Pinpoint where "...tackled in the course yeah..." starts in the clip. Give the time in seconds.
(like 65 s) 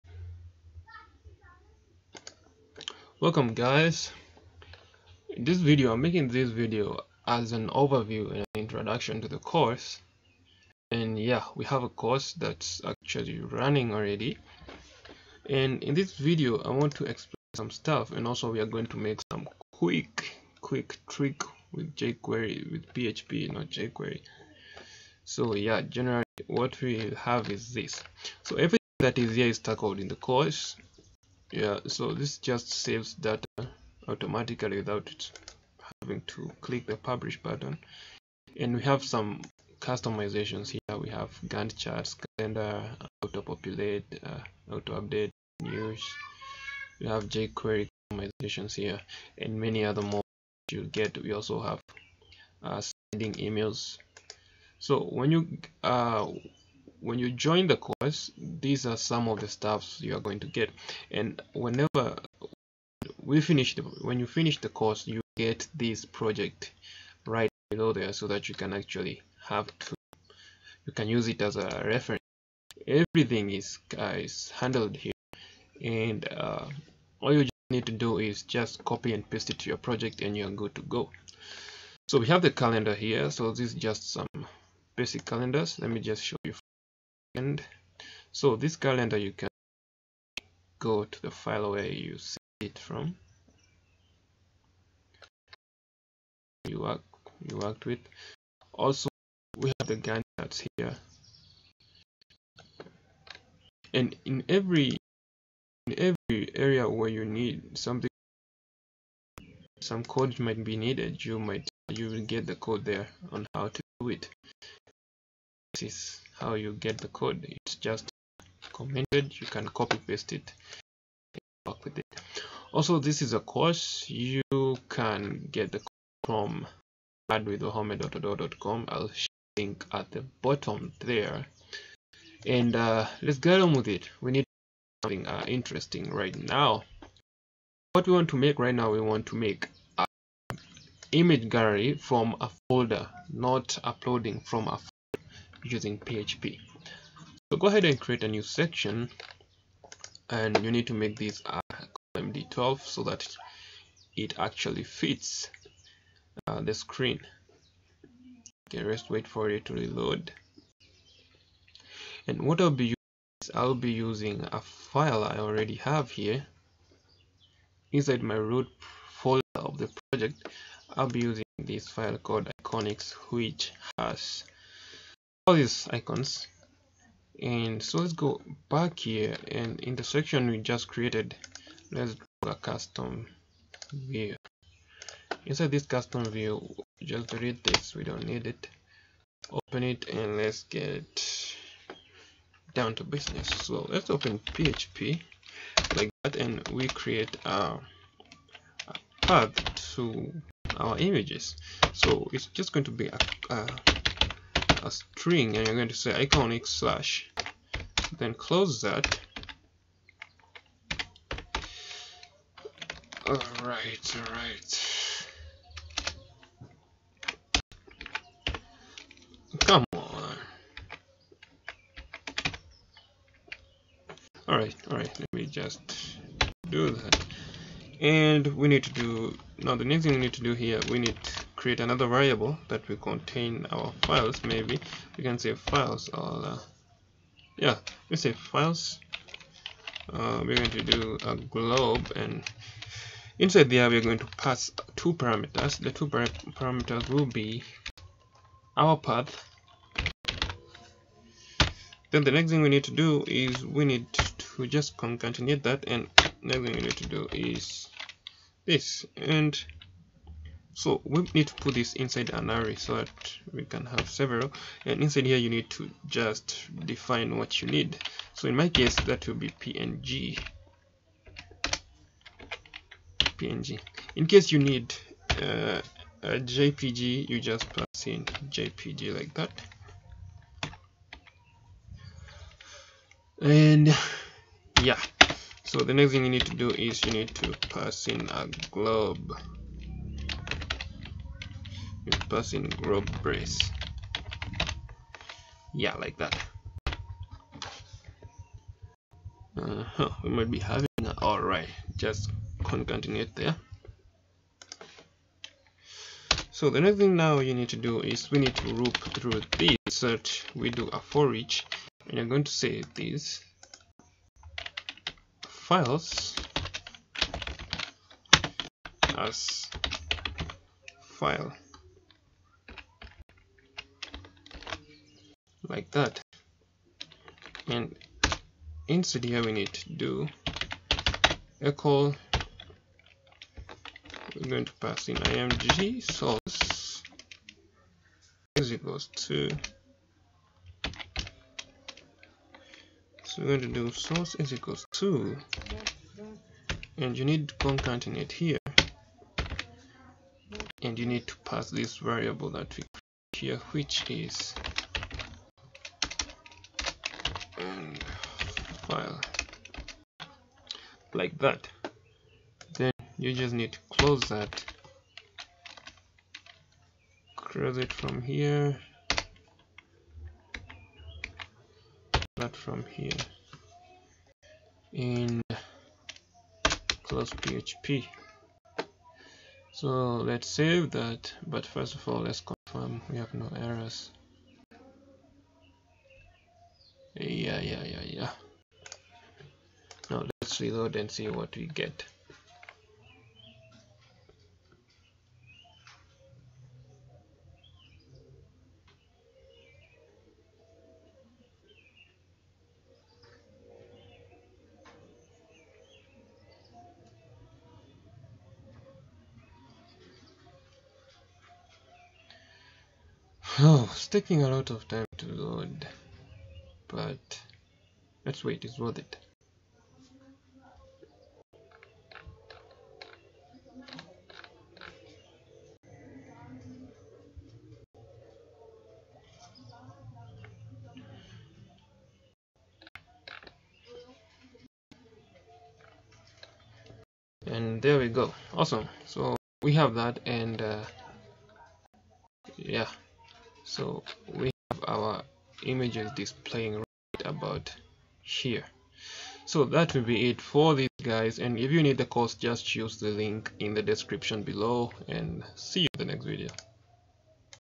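29 s.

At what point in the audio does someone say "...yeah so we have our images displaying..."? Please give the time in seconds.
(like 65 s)
442 s.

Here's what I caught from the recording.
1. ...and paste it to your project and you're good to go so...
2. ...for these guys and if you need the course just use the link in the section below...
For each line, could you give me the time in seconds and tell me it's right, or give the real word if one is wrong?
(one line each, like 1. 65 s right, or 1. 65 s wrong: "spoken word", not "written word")
1. 79 s right
2. 450 s wrong: "description", not "section".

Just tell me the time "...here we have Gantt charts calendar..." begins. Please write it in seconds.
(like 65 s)
40 s.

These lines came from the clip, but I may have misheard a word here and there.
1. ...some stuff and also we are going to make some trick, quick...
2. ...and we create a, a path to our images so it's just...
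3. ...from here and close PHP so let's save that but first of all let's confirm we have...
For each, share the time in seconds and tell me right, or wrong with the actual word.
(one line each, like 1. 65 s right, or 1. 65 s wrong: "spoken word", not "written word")
1. 17 s wrong: "quick", not "trick"
2. 196 s right
3. 372 s right.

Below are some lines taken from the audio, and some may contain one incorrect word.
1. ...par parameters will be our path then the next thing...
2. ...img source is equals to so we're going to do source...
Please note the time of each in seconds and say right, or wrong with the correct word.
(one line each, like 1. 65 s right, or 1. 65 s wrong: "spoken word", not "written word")
1. 246 s right
2. 335 s right.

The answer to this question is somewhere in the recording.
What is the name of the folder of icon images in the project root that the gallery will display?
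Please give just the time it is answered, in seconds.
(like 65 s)
172 s.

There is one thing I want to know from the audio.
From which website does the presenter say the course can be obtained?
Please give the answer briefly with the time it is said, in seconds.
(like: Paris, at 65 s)
radwithwahome.com, at 127 s.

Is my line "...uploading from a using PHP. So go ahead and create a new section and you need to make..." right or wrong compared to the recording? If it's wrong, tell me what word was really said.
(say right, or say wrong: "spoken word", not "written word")
right.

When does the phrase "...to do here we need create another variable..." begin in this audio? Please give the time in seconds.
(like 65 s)
230 s.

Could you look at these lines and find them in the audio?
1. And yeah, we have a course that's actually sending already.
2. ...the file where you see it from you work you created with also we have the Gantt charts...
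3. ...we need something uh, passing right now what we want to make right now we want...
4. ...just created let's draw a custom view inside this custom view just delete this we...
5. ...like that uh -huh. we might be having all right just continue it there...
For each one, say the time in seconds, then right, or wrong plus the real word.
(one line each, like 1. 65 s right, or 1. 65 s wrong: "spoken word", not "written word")
1. 10 s wrong: "running", not "sending"
2. 91 s wrong: "worked", not "created"
3. 134 s wrong: "interesting", not "passing"
4. 180 s right
5. 295 s right.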